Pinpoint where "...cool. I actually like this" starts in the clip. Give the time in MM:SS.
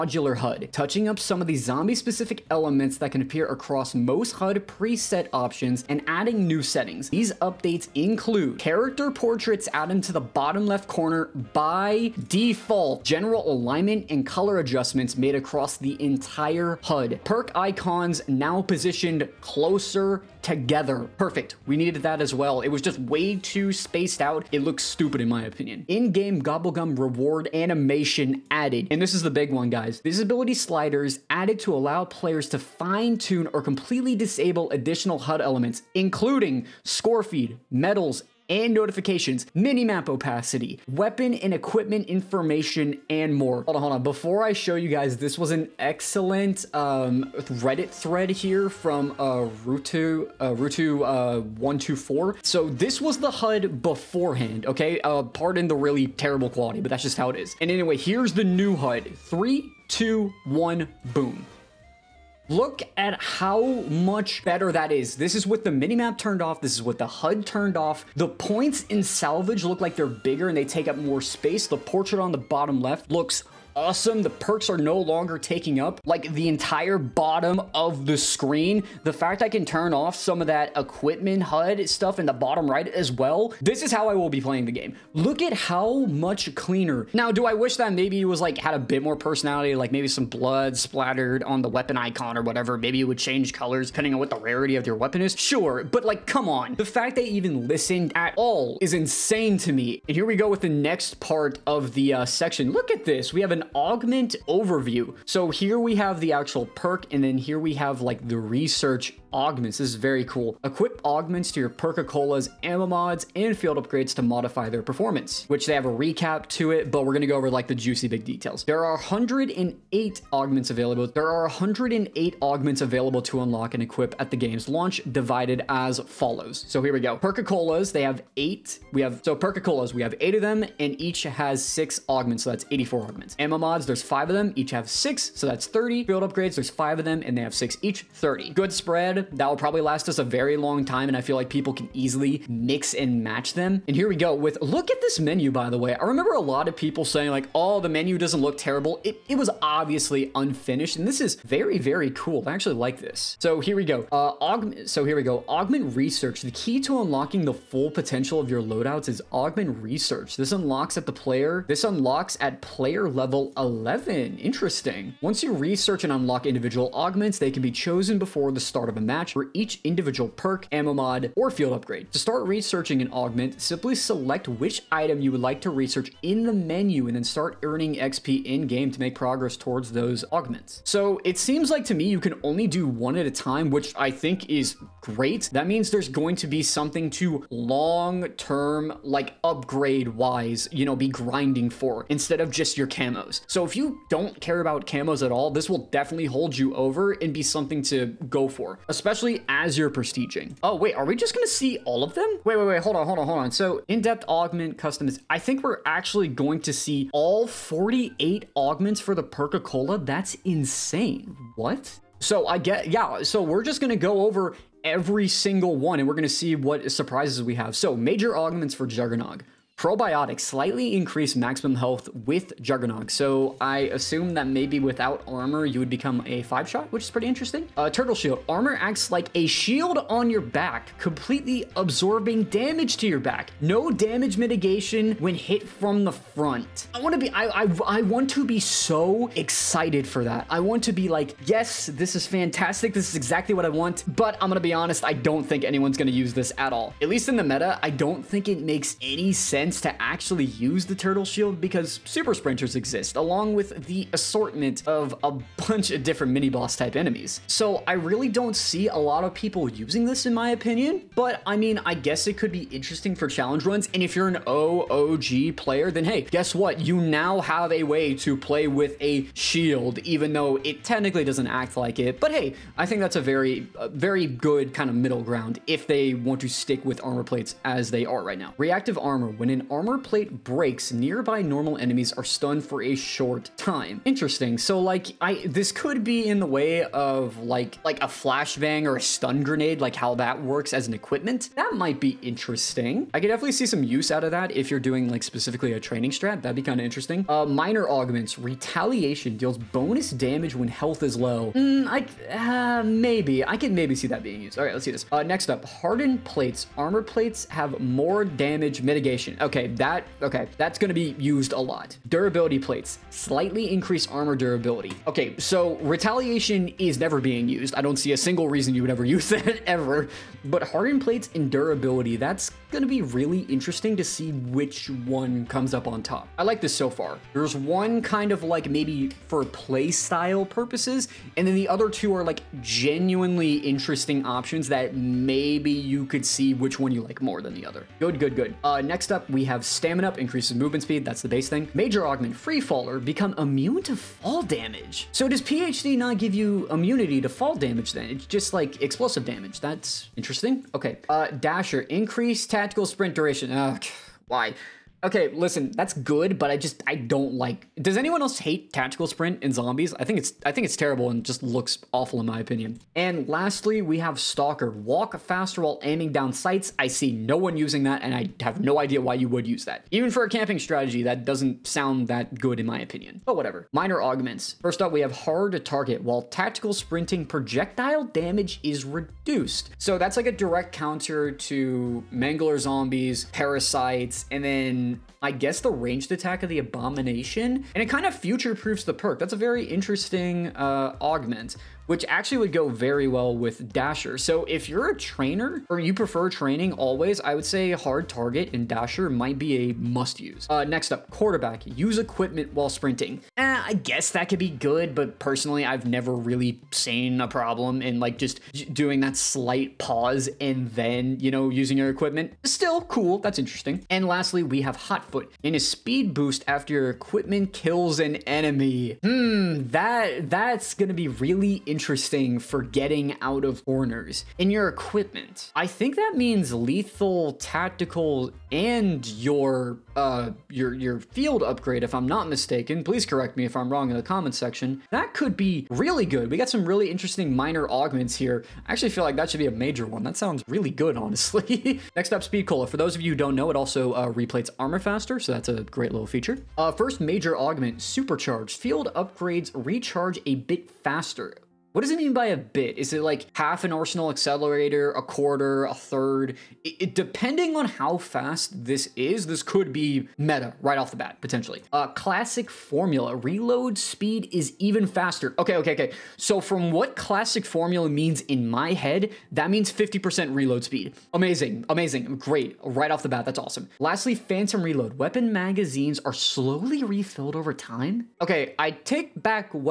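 02:32.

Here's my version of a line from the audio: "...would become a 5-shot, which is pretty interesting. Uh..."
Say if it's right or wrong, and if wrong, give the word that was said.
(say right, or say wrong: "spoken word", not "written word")
right.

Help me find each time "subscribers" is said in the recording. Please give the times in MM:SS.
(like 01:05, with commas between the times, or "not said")
not said.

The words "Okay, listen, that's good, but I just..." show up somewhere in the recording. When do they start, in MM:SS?
05:55.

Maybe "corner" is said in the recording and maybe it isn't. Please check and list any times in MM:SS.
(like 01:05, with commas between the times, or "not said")
00:10, 07:03.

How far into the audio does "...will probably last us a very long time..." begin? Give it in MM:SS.
02:19.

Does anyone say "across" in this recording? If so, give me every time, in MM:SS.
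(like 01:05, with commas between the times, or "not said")
00:03, 00:15.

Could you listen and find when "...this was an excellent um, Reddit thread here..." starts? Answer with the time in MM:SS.
00:45.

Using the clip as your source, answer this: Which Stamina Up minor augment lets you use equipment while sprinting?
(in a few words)
Quarterback.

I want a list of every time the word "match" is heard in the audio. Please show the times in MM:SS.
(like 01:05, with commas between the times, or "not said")
02:23, 02:49.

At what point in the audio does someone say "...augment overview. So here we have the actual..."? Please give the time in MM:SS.
01:43.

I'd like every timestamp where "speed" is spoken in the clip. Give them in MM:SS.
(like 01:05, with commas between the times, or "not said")
05:40, 06:55, 07:22, 07:43, 07:50.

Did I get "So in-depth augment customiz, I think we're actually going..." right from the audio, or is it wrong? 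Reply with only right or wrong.
right.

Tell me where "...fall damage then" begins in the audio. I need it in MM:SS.
05:47.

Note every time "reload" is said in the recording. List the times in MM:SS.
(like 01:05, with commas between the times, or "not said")
07:43, 07:50, 07:54.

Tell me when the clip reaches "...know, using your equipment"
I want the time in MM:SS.
06:51.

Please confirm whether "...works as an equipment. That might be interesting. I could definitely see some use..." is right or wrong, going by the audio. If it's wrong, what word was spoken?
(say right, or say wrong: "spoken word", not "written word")
right.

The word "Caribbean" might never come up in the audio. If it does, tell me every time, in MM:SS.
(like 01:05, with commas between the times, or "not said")
not said.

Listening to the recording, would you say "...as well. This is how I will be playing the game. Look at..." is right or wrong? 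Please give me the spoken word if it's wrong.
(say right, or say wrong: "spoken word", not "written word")
right.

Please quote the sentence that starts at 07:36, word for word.
It, it, depending on how fast this is, this could be meta right off the bat, potentially.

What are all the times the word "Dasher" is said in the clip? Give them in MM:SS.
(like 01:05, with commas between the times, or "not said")
05:51, 06:33, 06:38.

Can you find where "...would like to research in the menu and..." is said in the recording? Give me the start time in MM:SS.
02:55.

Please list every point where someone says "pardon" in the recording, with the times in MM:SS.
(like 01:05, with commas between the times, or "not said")
00:55.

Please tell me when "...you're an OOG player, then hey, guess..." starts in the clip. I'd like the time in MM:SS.
04:24.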